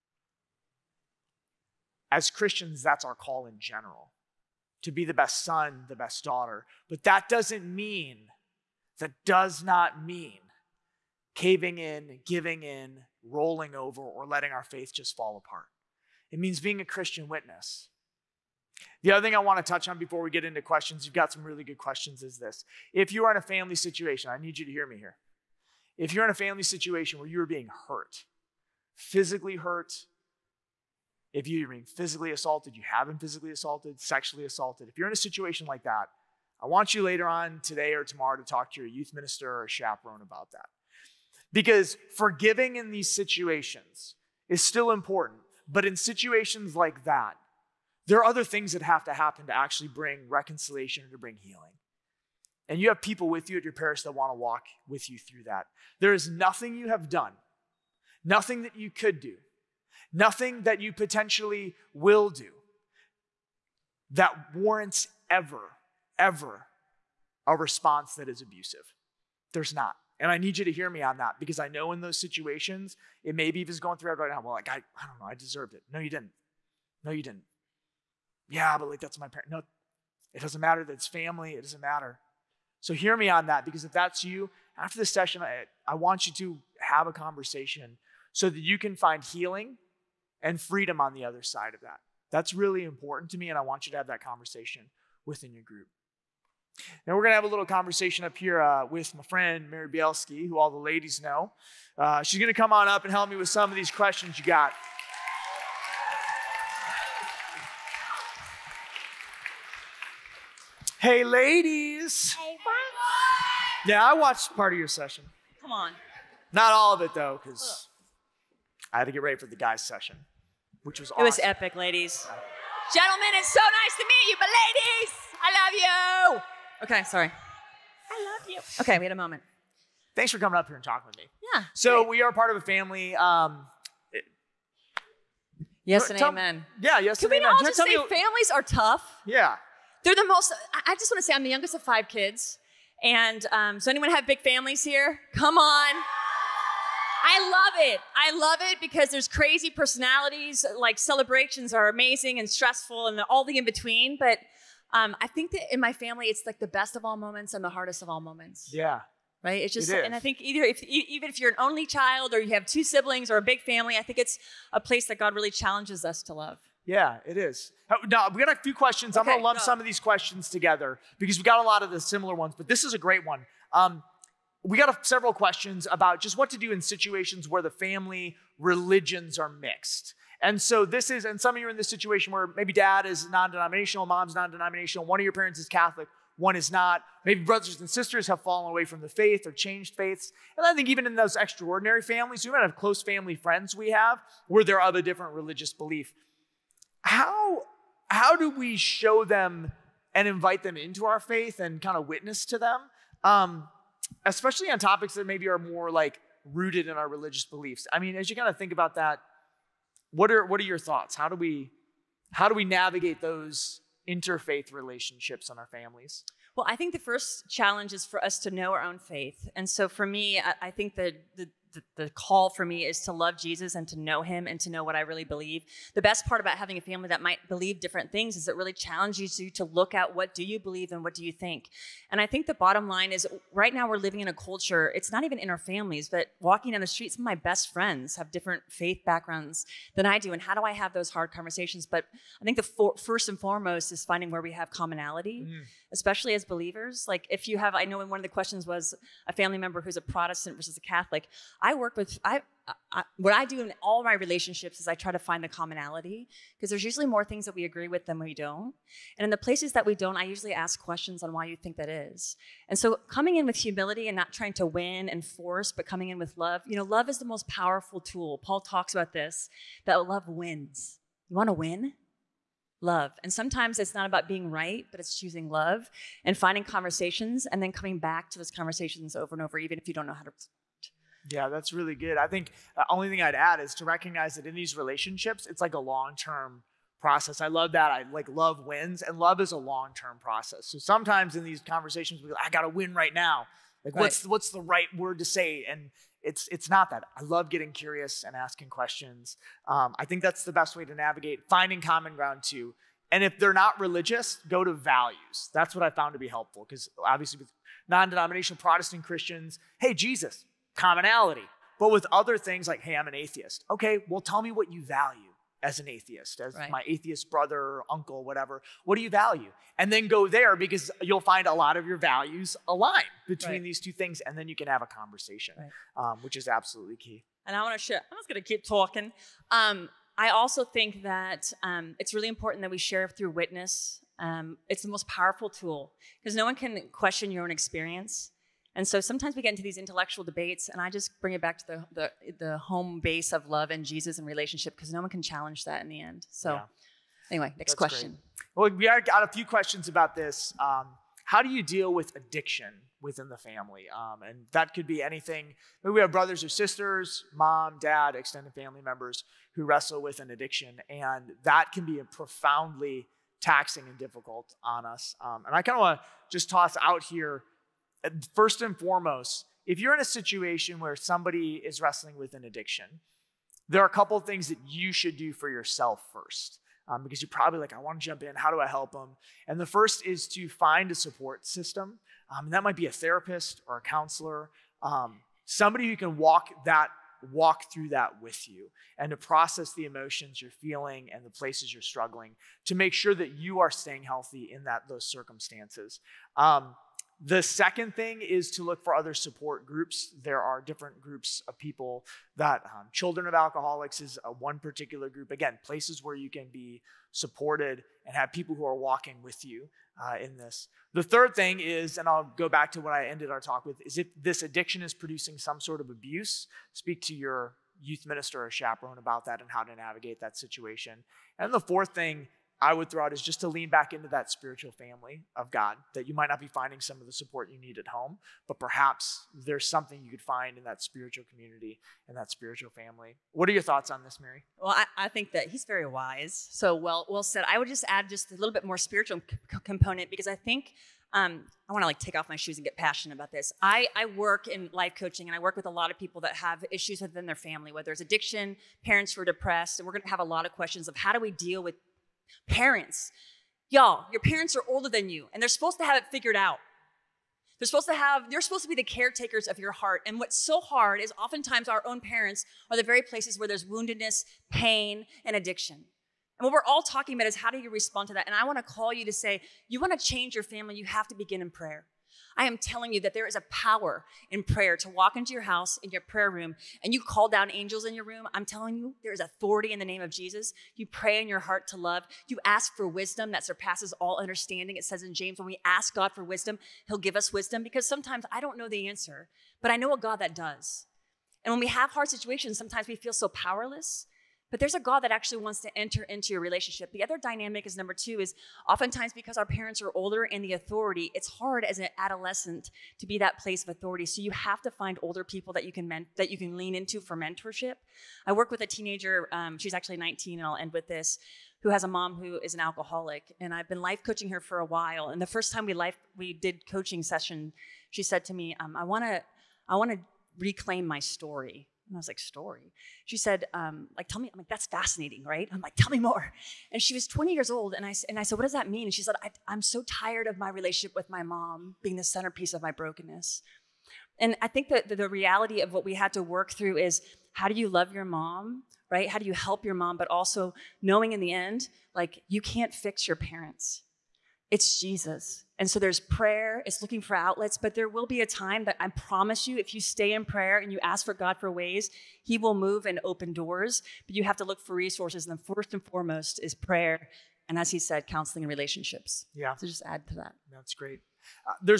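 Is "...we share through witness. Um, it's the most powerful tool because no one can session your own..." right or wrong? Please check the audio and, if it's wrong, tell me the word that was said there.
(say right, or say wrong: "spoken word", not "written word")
wrong: "question", not "session".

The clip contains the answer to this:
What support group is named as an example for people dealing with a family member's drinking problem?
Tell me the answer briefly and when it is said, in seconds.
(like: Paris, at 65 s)
Children of Alcoholics, at 402 s.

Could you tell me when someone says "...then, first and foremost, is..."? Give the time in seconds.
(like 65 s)
555 s.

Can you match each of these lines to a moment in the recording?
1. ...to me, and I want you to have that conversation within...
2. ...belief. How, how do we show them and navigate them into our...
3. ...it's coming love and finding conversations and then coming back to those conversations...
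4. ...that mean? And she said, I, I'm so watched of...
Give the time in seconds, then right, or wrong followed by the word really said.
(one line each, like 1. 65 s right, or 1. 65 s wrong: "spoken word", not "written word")
1. 93 s right
2. 195 s wrong: "invite", not "navigate"
3. 274 s wrong: "choosing", not "coming"
4. 528 s wrong: "tired", not "watched".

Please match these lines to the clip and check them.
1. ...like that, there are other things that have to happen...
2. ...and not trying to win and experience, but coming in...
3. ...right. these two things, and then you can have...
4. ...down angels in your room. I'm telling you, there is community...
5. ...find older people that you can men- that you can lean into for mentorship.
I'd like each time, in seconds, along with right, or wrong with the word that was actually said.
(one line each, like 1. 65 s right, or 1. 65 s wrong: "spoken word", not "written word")
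1. 46 s right
2. 264 s wrong: "force", not "experience"
3. 323 s right
4. 477 s wrong: "authority", not "community"
5. 504 s right.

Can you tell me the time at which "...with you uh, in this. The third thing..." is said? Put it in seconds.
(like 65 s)
409 s.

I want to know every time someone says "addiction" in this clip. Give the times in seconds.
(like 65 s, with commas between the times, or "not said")
352 s, 360 s, 372 s, 414 s, 448 s, 465 s.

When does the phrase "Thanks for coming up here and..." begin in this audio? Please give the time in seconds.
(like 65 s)
130 s.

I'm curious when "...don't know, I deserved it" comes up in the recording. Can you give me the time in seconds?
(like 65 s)
75 s.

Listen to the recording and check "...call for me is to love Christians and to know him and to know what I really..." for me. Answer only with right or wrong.
wrong.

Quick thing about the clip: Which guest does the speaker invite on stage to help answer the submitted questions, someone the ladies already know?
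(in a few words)
Mary Bielski.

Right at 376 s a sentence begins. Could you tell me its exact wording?
Um, because you're probably like, I want to jump in.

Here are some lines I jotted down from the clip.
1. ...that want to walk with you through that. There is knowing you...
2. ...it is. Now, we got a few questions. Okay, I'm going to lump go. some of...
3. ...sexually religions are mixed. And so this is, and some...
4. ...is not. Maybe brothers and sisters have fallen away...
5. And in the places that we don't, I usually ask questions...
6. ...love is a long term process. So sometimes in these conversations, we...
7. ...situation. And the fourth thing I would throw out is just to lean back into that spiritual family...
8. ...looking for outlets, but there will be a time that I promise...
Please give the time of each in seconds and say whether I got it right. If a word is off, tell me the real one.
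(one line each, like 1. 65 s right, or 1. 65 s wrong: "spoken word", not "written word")
1. 54 s wrong: "nothing", not "knowing"
2. 167 s right
3. 177 s wrong: "family", not "sexually"
4. 186 s right
5. 259 s right
6. 289 s right
7. 420 s right
8. 546 s right.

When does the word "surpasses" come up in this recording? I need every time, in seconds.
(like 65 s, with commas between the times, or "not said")
483 s.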